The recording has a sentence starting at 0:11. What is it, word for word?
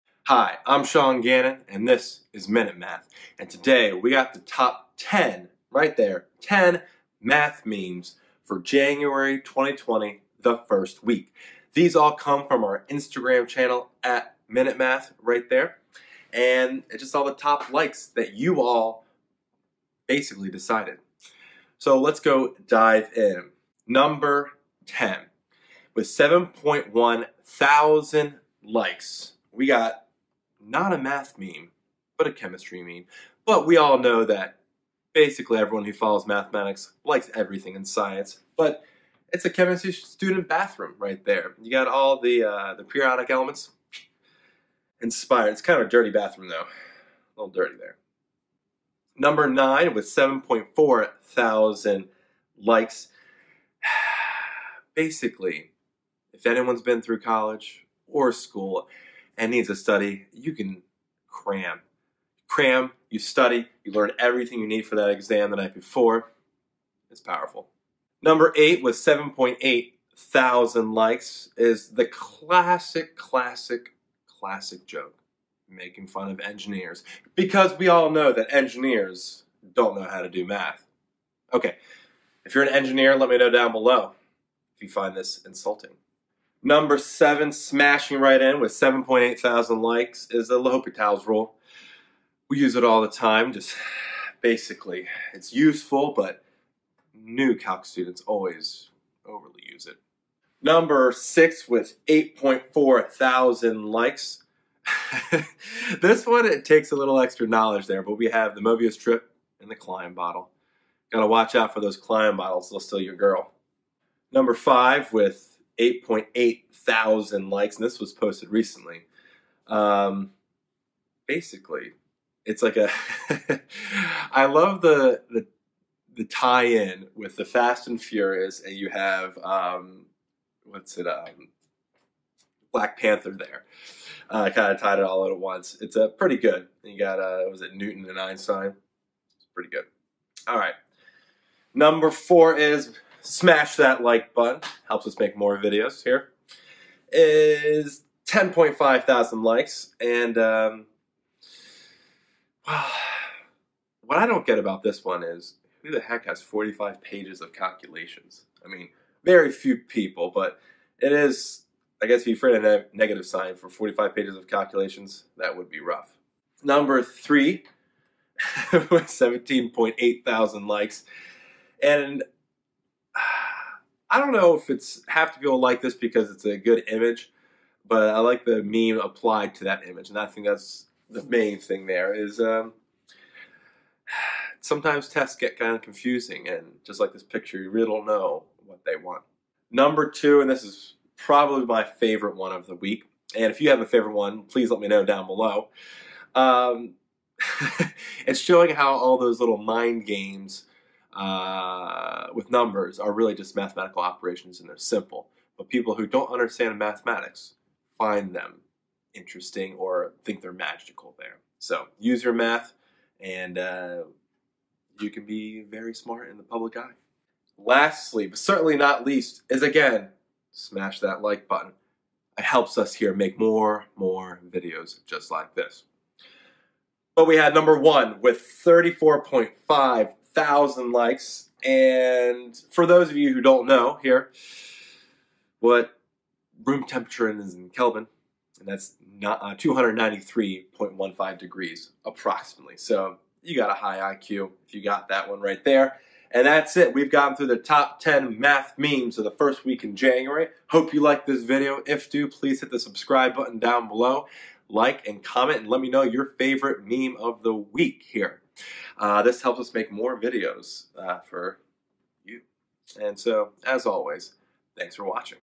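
These all come from our Instagram channel at Minute Math, right there.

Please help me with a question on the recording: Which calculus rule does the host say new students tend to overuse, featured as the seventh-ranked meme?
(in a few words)
L'Hopital's rule.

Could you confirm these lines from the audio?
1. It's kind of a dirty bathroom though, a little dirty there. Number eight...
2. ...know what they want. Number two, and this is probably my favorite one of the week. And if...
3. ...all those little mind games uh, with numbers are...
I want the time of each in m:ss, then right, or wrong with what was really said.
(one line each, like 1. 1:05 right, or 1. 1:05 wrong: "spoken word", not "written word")
1. 0:45 wrong: "nine", not "eight"
2. 3:08 right
3. 3:18 right.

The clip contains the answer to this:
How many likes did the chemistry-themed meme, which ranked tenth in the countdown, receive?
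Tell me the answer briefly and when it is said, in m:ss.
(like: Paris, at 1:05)
7.1 thousand, at 0:26.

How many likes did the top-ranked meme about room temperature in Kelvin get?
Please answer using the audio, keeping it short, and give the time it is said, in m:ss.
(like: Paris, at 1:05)
34.5 thousand, at 3:48.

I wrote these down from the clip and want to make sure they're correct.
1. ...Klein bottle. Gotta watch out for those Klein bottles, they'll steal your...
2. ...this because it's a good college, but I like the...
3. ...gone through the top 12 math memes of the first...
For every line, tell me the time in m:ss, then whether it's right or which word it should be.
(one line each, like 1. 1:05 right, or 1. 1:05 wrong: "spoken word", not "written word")
1. 1:49 right
2. 2:55 wrong: "image", not "college"
3. 4:07 wrong: "10", not "12".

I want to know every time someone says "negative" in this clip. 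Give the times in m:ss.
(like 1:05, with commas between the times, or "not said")
2:42.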